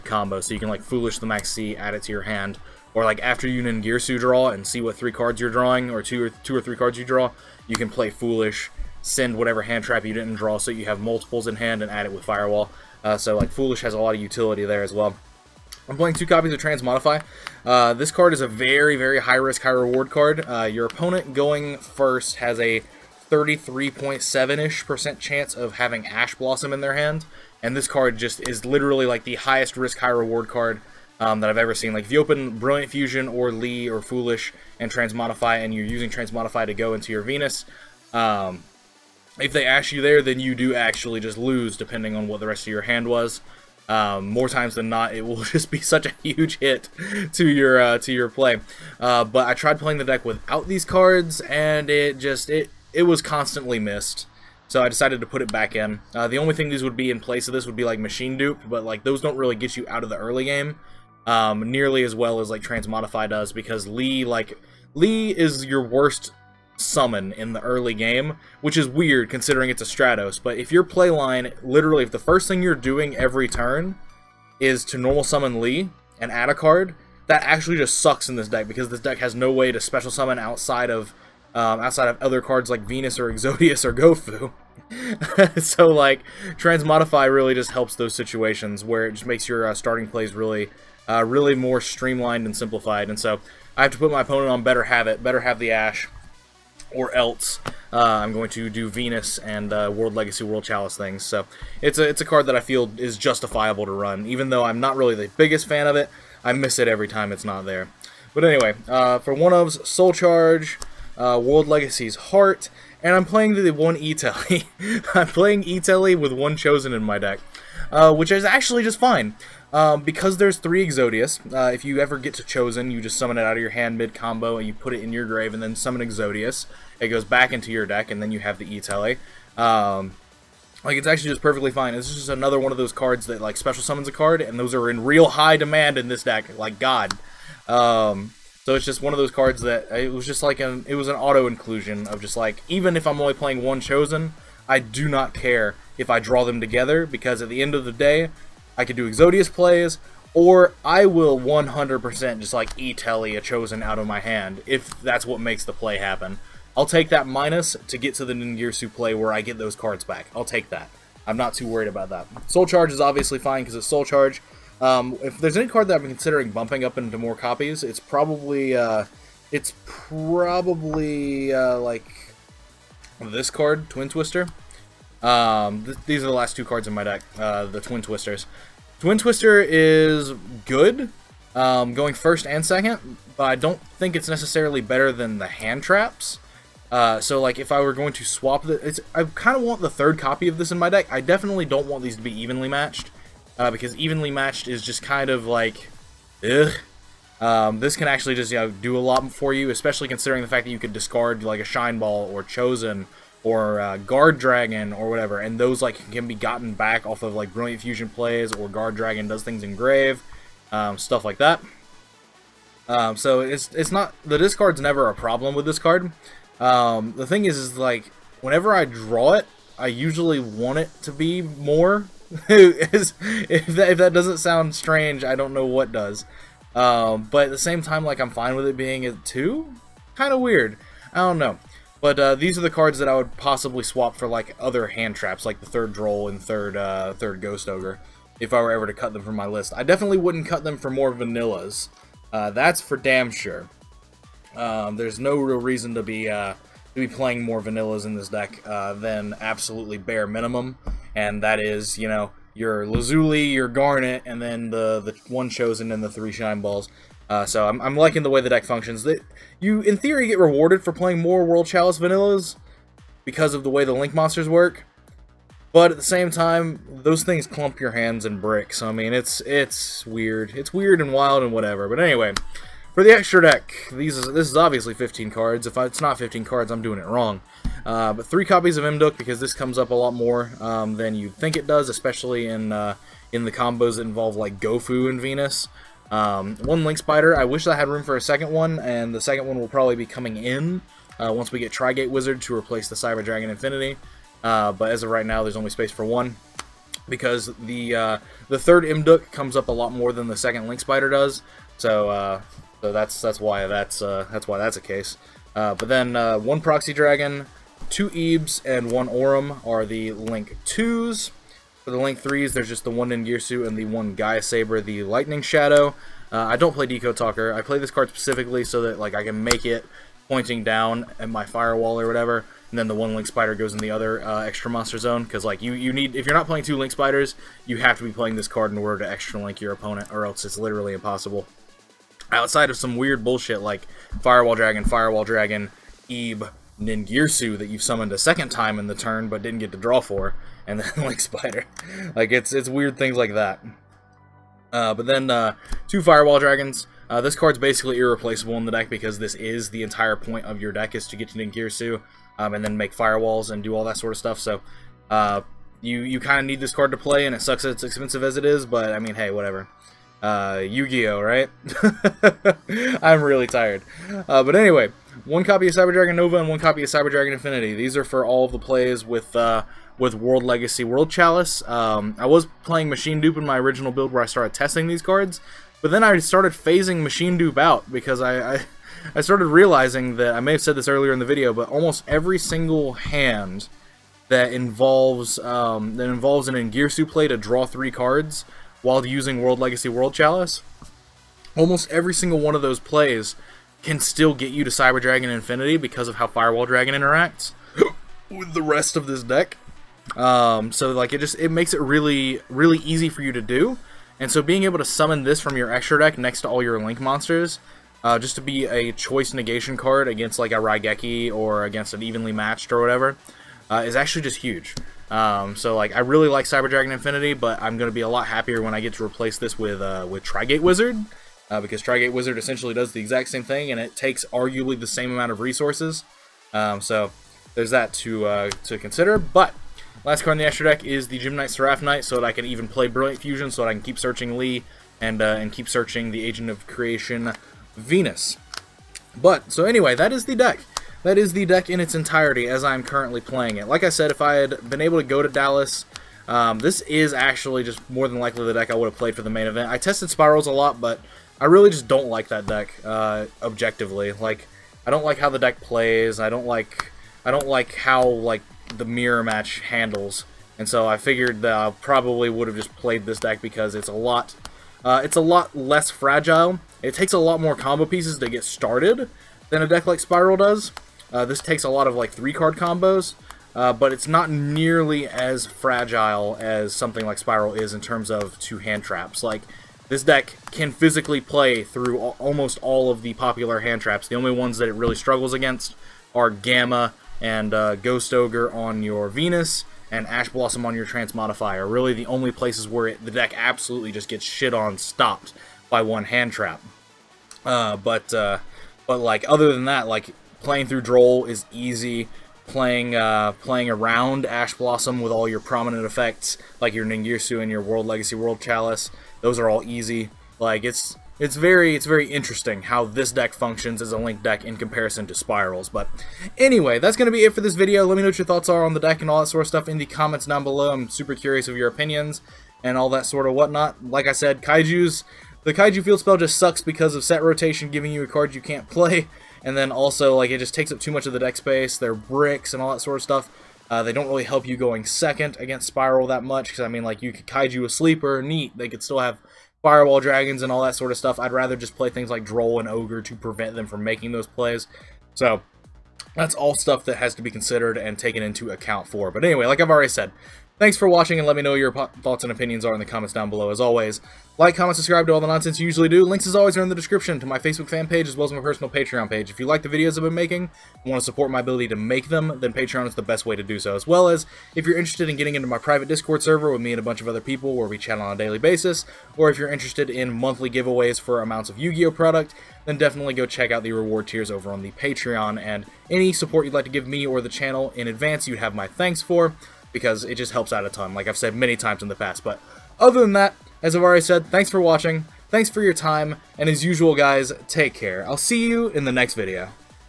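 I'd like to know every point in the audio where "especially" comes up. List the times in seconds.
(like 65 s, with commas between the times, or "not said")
199 s, 281 s.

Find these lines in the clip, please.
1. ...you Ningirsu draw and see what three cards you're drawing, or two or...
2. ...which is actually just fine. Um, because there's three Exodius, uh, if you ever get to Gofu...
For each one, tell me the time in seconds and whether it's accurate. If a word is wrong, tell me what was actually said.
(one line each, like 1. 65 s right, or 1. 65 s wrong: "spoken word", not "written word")
1. 3 s right
2. 118 s wrong: "Chosen", not "Gofu".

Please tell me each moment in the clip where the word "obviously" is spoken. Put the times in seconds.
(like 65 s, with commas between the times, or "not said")
162 s, 274 s.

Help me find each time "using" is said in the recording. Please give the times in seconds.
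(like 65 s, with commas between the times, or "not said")
35 s, 389 s.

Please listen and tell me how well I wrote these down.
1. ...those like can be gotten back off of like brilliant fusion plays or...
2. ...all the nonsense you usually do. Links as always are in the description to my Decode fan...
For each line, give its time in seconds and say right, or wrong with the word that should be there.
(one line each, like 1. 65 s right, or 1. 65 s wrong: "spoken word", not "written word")
1. 205 s right
2. 555 s wrong: "Facebook", not "Decode".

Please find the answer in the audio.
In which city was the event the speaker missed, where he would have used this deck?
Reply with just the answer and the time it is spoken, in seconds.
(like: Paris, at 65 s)
Dallas, at 445 s.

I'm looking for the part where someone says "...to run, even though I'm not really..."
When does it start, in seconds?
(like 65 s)
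103 s.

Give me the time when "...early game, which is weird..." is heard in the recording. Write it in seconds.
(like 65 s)
67 s.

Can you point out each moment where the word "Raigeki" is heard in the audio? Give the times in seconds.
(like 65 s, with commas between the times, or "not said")
410 s.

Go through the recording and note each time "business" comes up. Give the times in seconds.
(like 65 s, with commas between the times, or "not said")
not said.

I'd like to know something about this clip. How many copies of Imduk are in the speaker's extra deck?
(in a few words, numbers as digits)
3.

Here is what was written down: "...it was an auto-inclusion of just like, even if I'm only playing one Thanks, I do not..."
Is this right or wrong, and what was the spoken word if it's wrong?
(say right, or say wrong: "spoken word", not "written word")
wrong: "Chosen", not "Thanks".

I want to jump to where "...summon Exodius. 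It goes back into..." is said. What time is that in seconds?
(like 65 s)
125 s.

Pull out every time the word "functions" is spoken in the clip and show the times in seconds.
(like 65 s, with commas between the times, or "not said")
258 s, 513 s.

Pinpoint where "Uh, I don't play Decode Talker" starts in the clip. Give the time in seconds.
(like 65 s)
316 s.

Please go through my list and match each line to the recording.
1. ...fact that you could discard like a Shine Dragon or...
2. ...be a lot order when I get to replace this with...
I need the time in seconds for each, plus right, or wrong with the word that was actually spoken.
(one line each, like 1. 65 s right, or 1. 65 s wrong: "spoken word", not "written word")
1. 200 s wrong: "Ball", not "Dragon"
2. 417 s wrong: "happier", not "order".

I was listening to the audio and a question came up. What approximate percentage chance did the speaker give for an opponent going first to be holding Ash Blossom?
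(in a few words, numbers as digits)
33.7%.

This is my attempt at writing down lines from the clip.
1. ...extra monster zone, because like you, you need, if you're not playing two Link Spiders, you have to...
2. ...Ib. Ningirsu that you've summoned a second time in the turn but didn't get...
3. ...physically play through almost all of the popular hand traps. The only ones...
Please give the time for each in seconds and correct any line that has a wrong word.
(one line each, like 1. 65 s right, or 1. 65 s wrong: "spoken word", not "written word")
1. 324 s right
2. 336 s right
3. 480 s right.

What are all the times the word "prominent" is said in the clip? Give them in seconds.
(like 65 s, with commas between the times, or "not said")
505 s.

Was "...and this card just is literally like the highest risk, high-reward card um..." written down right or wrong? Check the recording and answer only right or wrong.
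right.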